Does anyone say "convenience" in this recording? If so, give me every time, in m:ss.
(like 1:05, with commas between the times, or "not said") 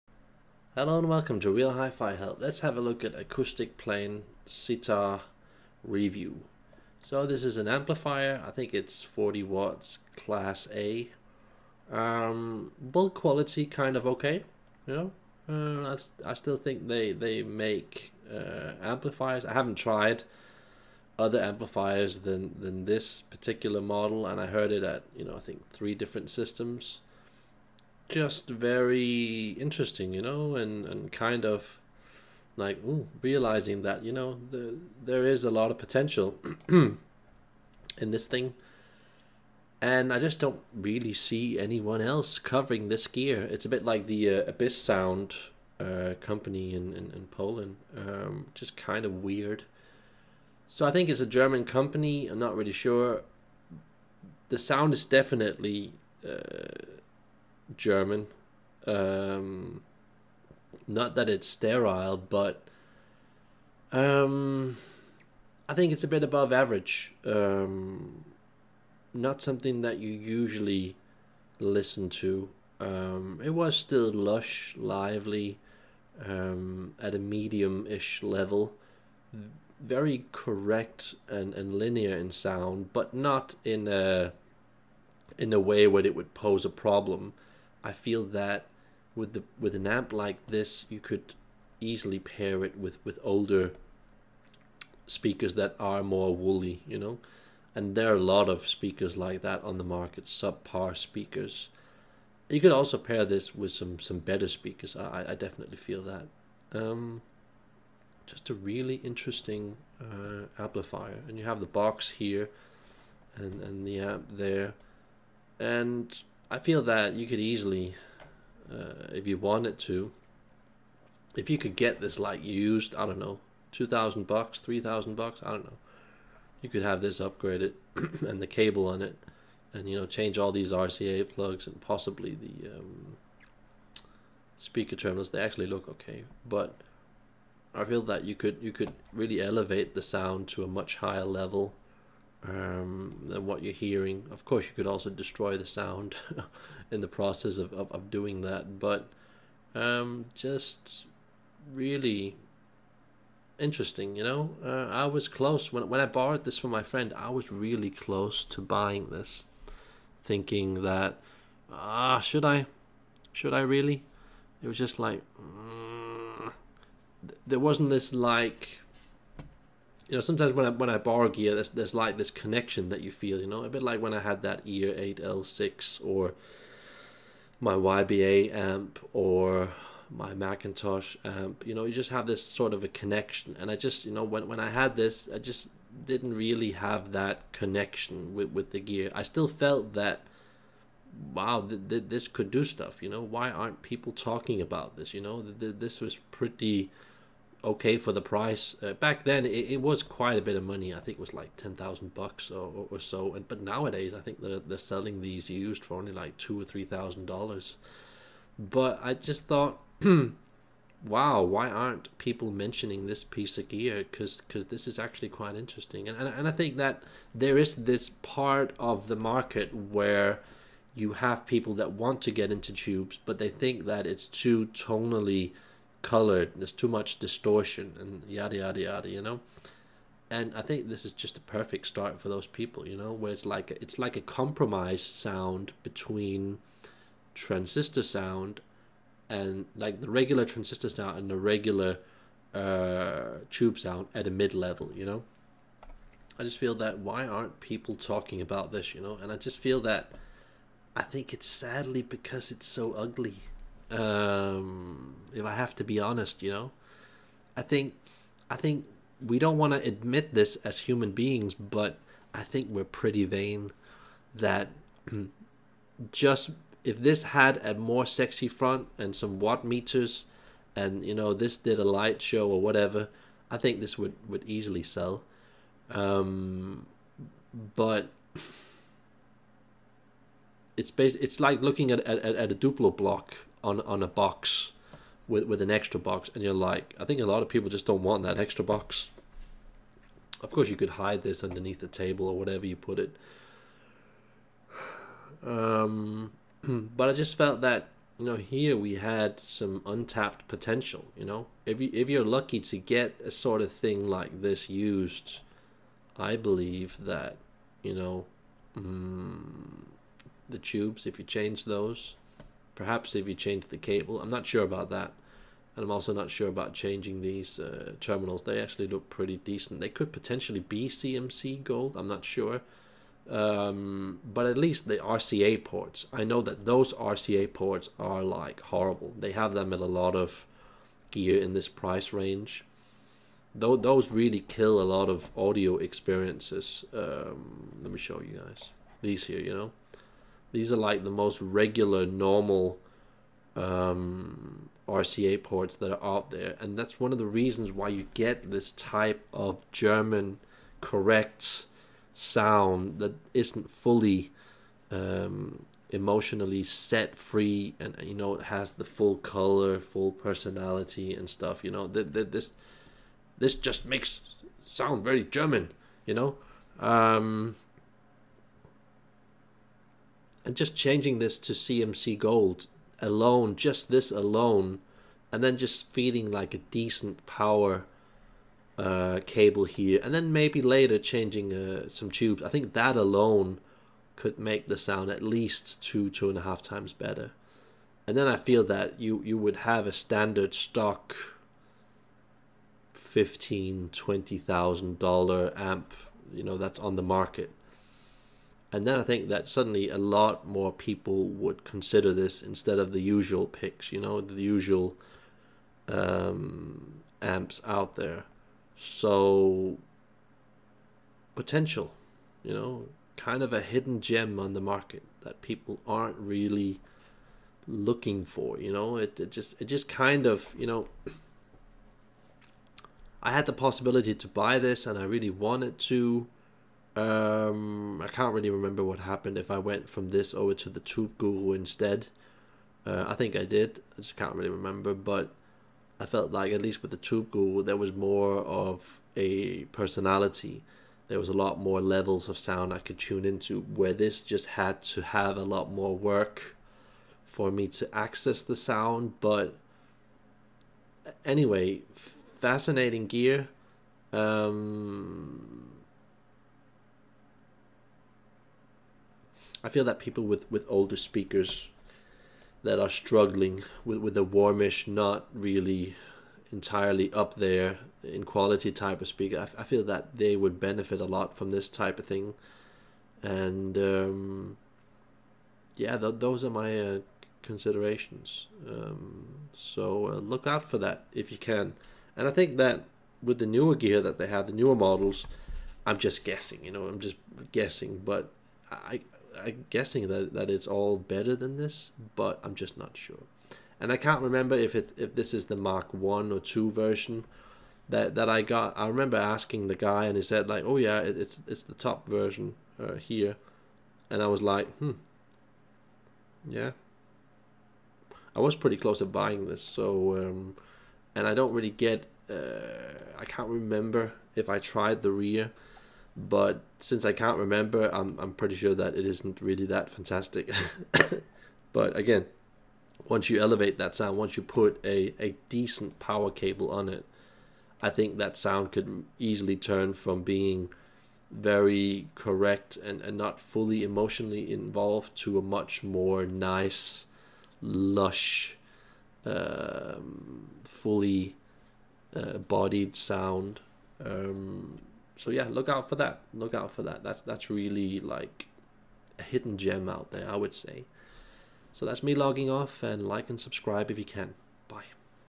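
not said.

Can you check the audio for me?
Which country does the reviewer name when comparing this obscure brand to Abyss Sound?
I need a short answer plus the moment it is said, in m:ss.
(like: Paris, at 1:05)
Poland, at 0:47.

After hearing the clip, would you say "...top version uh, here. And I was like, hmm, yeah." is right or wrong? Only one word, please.
right.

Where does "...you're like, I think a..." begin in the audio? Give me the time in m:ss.
4:46.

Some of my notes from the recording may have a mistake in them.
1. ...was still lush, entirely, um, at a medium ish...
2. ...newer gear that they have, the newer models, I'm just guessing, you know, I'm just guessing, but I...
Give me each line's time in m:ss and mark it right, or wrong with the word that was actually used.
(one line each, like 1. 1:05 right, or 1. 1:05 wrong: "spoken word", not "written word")
1. 1:13 wrong: "lively", not "entirely"
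2. 8:03 right.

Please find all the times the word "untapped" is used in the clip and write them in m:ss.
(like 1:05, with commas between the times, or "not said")
4:59.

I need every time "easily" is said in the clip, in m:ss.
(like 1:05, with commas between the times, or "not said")
1:31, 1:57, 4:34, 8:49.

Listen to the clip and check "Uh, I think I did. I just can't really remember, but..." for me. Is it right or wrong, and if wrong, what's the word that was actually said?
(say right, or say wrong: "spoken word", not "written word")
right.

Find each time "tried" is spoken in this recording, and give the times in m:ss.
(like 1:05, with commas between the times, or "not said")
0:19, 8:34.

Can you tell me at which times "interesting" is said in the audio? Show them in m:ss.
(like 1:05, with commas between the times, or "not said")
0:29, 1:49, 2:33, 3:35.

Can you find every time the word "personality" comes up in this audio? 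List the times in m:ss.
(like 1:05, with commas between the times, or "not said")
6:00, 7:19.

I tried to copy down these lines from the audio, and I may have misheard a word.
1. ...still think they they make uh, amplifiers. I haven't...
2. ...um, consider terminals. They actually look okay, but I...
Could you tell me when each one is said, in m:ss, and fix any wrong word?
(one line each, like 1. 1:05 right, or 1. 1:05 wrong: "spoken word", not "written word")
1. 0:16 right
2. 2:12 wrong: "speaker", not "consider".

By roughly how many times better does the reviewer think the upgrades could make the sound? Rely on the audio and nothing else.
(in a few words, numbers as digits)
2.5 times.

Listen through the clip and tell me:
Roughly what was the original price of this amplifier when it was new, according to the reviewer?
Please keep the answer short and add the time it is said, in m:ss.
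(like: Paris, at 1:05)
$10,000, at 3:21.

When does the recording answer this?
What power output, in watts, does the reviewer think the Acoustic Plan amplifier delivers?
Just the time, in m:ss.
0:09.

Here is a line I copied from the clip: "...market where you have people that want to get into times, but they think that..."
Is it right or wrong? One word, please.
wrong.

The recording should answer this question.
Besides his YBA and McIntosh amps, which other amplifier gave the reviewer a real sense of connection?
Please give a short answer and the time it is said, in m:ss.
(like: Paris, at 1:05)
Ear 8L6, at 2:54.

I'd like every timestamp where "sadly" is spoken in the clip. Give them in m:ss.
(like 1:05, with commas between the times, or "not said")
4:11.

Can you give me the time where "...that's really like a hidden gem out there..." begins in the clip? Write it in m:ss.
9:07.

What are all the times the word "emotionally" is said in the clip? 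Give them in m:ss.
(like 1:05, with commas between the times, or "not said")
5:55, 8:53.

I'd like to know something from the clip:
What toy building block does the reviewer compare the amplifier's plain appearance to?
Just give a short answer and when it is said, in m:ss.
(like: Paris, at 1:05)
Duplo block, at 4:42.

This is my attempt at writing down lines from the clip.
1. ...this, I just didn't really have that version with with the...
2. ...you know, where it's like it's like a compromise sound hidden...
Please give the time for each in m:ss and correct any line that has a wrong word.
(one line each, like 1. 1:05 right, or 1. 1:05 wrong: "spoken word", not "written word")
1. 3:04 wrong: "connection", not "version"
2. 3:52 wrong: "between", not "hidden".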